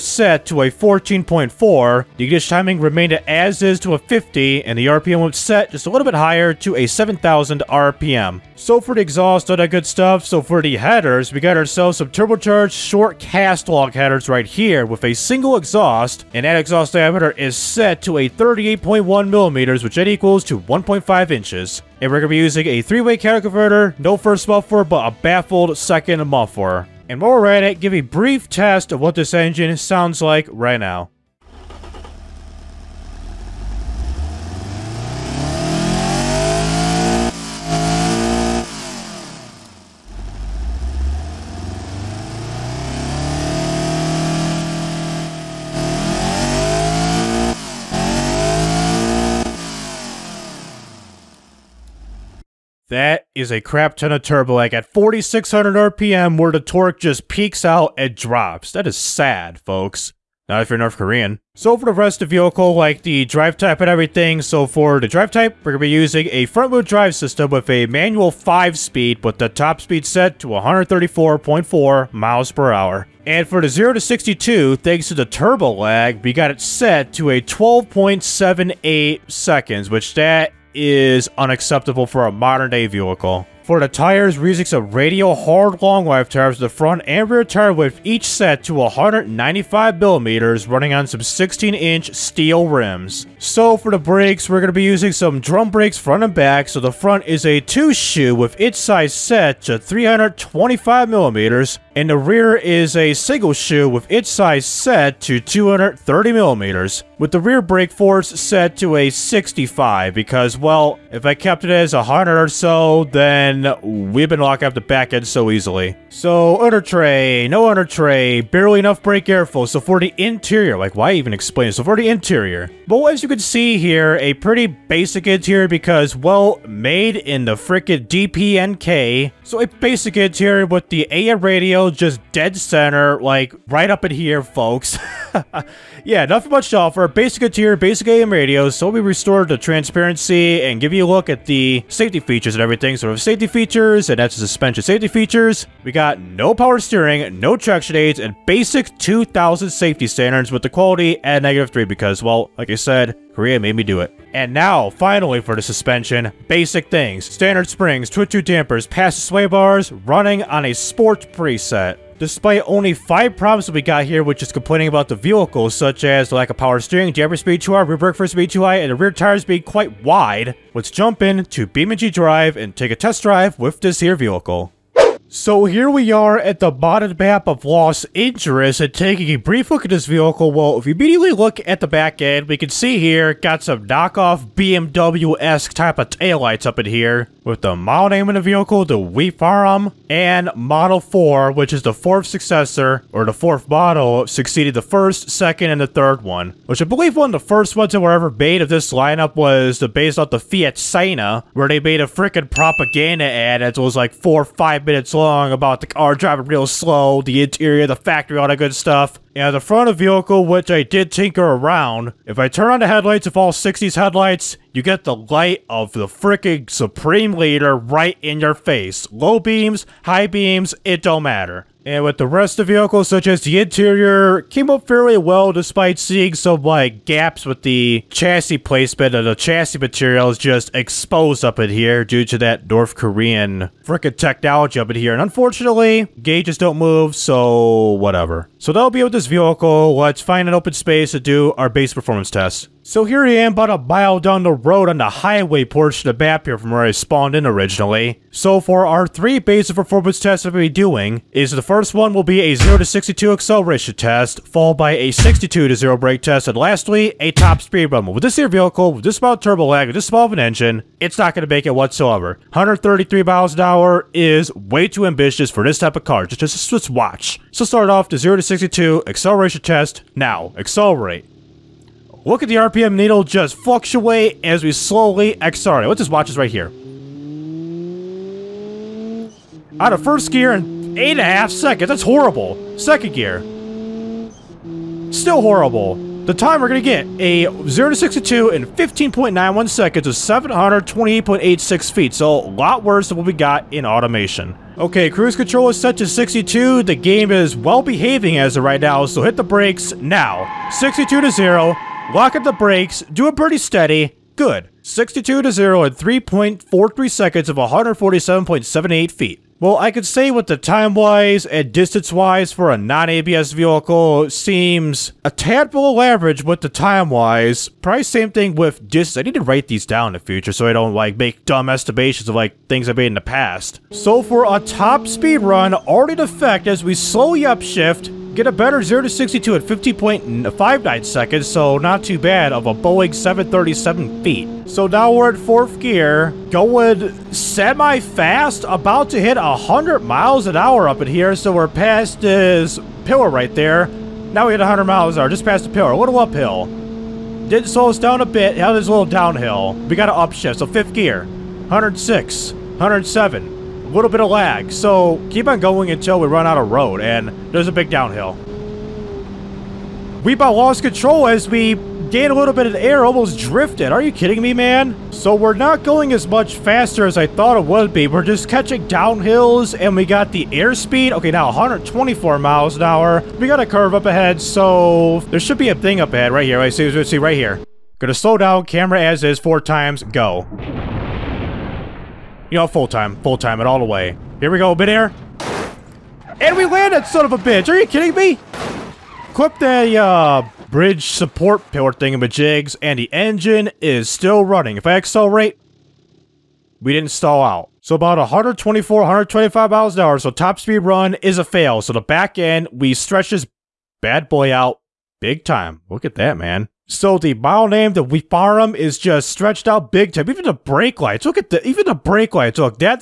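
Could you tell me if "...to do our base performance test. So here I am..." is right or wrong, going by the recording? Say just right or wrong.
right.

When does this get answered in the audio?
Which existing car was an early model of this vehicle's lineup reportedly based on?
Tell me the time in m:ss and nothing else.
3:20.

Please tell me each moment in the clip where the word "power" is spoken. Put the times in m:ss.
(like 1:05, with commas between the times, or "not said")
2:26, 2:46.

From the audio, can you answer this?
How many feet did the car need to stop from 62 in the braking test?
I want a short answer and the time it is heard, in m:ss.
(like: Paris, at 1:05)
147.78 feet, at 5:07.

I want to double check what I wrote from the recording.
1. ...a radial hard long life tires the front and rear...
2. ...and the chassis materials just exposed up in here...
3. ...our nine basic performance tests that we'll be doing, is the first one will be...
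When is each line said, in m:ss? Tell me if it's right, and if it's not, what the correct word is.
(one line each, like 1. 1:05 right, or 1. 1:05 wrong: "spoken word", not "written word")
1. 1:24 right
2. 3:49 right
3. 4:08 wrong: "three", not "nine".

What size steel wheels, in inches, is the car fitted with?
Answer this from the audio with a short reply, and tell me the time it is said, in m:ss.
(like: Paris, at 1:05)
16 inch, at 1:31.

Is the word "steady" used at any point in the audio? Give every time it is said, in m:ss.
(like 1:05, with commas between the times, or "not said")
5:03.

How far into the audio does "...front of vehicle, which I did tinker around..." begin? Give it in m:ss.
3:29.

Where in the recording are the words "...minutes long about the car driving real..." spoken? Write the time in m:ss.
3:24.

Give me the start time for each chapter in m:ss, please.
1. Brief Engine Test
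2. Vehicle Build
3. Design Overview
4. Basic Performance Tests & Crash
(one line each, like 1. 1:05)
1. 0:31
2. 1:01
3. 2:55
4. 4:03.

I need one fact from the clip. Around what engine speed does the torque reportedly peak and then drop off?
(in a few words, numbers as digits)
4,600 RPM.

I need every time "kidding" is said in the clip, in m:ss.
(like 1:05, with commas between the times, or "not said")
6:04, 6:27.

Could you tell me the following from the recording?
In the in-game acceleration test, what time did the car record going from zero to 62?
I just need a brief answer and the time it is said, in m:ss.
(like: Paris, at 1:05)
15.91 seconds, at 4:48.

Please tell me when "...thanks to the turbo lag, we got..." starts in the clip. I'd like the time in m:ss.
1:14.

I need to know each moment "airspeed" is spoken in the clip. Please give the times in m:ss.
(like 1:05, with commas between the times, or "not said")
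6:10.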